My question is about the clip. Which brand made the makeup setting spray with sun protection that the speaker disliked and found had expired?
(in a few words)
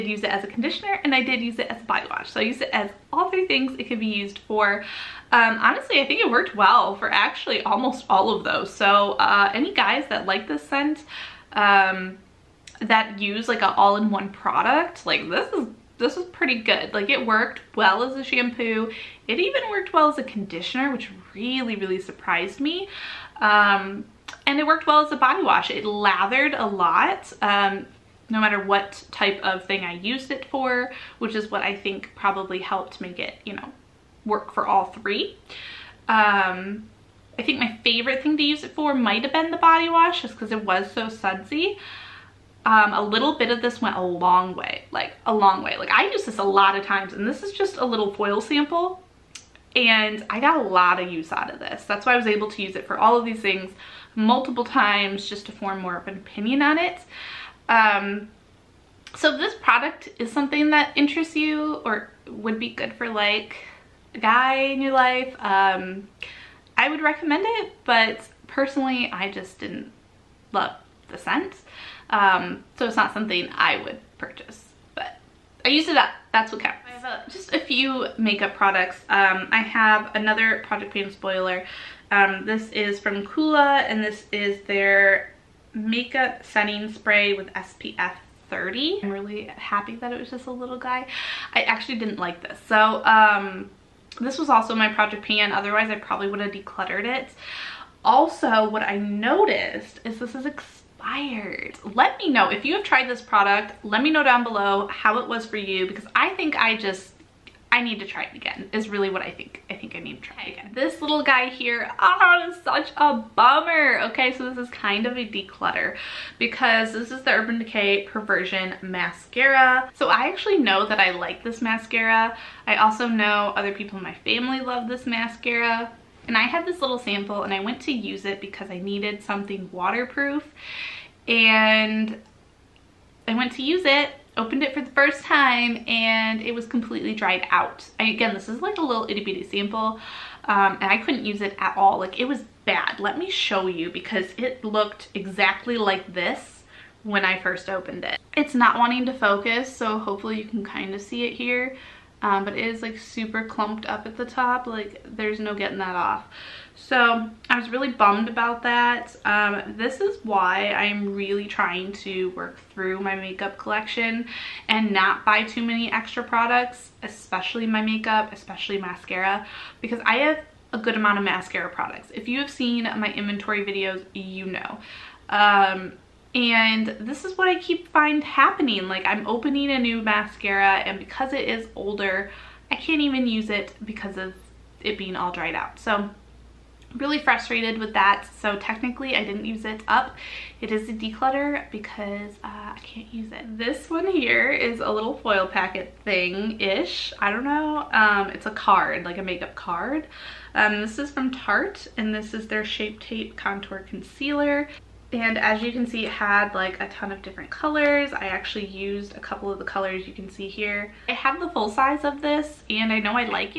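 Coola.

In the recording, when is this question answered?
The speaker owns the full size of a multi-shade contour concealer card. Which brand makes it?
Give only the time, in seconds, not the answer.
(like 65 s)
201 s.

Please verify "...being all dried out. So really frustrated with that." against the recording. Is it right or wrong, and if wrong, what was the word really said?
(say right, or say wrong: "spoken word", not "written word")
right.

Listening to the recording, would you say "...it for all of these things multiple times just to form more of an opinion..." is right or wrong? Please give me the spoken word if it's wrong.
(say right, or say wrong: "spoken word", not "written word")
right.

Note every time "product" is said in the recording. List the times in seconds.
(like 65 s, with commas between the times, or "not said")
14 s, 59 s, 78 s, 103 s, 166 s, 171 s.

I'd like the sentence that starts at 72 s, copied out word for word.
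Um, so it's not something I would purchase, but I used it up.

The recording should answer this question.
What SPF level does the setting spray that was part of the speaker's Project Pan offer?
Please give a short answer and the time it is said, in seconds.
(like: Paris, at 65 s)
SPF 30, at 87 s.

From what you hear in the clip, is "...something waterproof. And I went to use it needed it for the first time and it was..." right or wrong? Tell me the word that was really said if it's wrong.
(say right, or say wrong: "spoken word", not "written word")
wrong: "opened", not "needed".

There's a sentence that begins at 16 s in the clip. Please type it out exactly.
Like it worked well as a shampoo.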